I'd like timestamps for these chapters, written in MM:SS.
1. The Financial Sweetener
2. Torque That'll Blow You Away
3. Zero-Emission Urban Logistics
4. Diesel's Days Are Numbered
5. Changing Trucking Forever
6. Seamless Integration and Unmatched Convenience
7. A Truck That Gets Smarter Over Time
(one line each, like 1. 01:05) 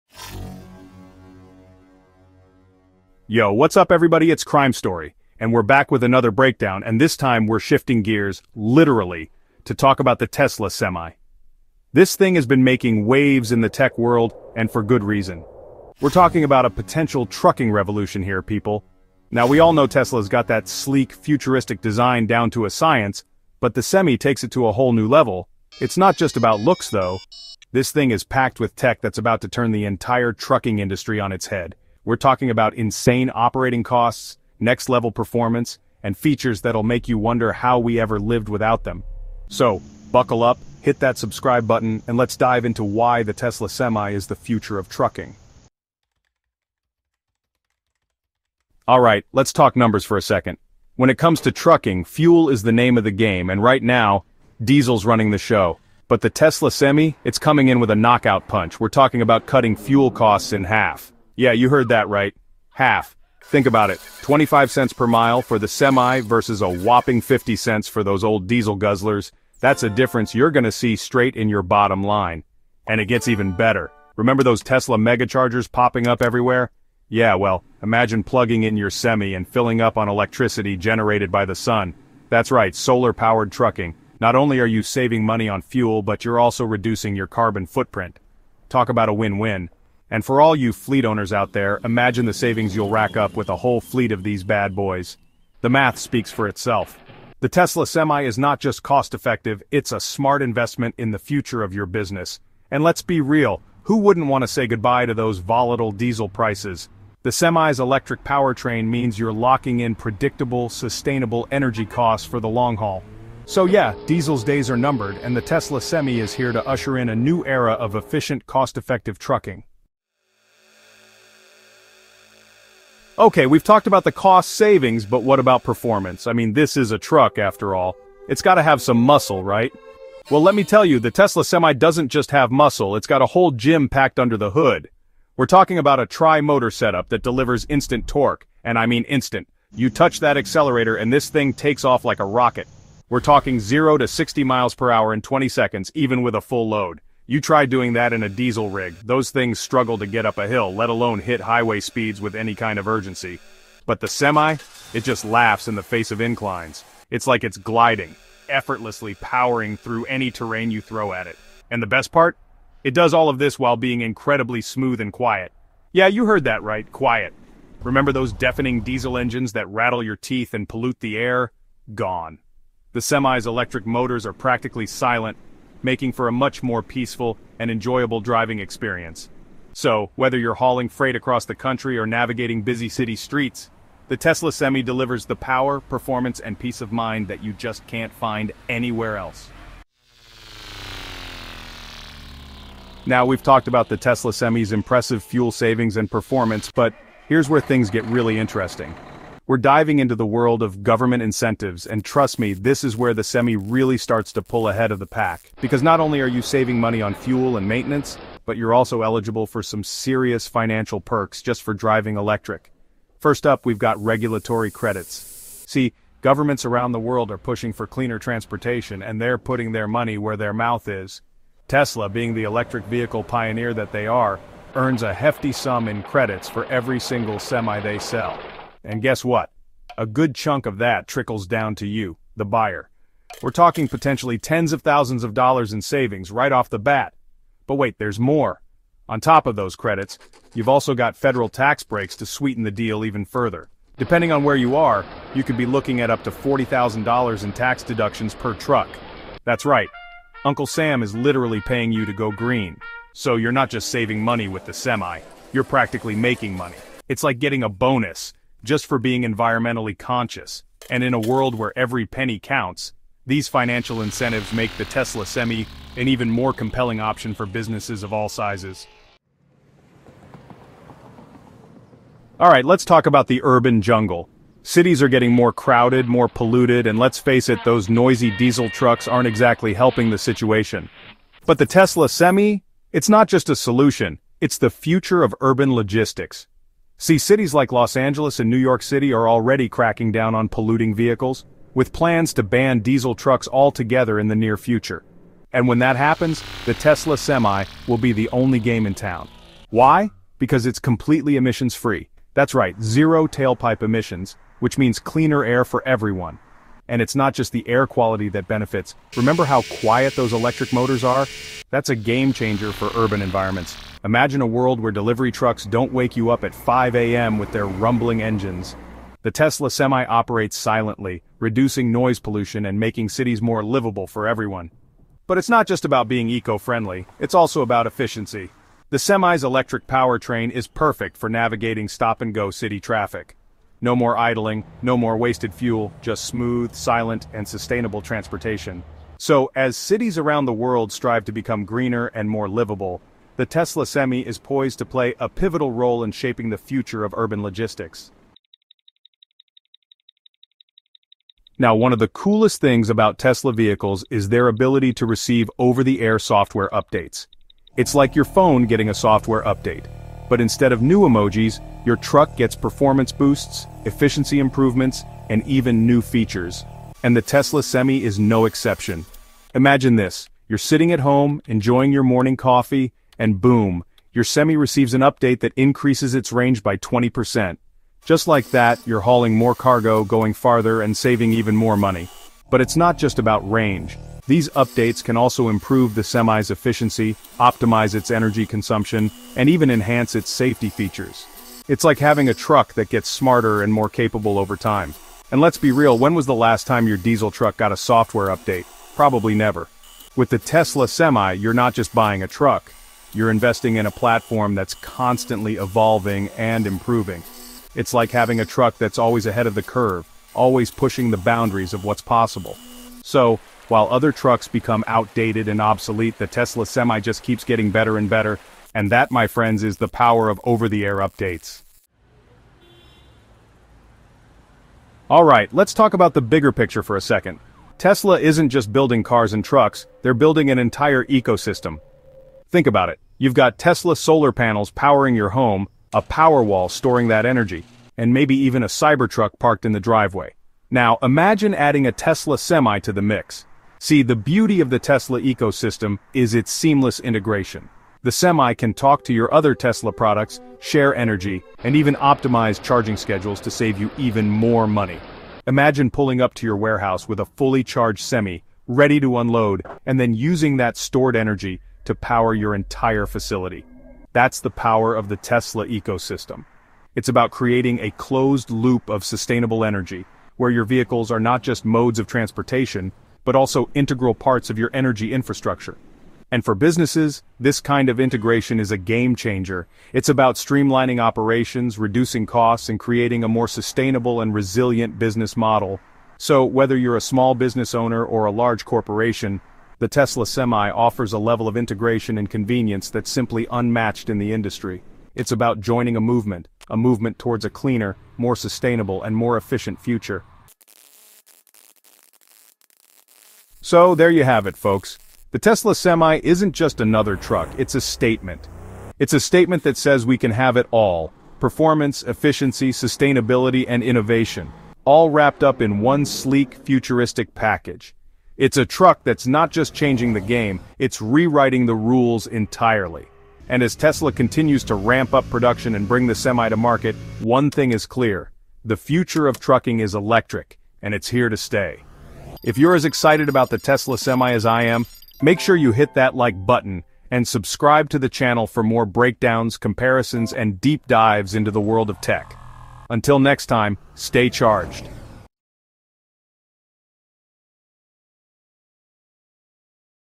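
1. 03:09
2. 01:59
3. 04:29
4. 00:45
5. 08:20
6. 07:01
7. 05:48.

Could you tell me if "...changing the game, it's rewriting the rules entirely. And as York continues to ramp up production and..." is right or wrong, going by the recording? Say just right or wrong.
wrong.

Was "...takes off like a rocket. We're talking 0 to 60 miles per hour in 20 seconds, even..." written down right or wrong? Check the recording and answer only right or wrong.
right.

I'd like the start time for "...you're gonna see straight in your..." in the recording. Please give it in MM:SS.
01:10.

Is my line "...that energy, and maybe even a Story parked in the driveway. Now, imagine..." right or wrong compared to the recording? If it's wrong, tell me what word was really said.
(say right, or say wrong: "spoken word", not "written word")
wrong: "Cybertruck", not "Story".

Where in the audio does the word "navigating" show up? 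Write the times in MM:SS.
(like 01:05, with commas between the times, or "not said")
03:02, 05:31.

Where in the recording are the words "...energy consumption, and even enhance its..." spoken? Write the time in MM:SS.
06:28.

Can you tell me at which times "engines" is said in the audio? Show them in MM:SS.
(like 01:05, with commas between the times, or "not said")
02:49, 05:18.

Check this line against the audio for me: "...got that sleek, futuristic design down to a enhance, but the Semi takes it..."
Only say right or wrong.
wrong.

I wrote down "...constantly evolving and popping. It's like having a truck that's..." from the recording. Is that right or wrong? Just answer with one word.
wrong.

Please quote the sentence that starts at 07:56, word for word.
And for businesses, this kind of integration is a game changer.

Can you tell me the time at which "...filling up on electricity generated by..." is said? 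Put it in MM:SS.
01:19.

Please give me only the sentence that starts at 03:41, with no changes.
Tesla, being the electric vehicle pioneer that they are, earns a hefty sum in credits for every single semi they sell.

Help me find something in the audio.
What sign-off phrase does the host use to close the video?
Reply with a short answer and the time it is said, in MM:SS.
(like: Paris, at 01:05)
stay charged, at 09:03.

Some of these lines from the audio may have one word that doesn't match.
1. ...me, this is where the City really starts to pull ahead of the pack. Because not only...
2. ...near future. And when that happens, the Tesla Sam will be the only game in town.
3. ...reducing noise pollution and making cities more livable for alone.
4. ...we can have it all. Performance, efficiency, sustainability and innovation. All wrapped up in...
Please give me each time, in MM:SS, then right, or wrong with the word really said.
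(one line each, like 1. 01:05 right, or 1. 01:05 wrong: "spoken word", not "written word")
1. 03:22 wrong: "Semi", not "City"
2. 04:54 wrong: "Semi", not "Sam"
3. 05:21 wrong: "everyone", not "alone"
4. 08:30 right.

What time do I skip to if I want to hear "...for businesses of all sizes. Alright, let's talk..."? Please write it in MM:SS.
04:27.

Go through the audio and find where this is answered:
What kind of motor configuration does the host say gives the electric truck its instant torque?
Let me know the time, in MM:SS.
02:16.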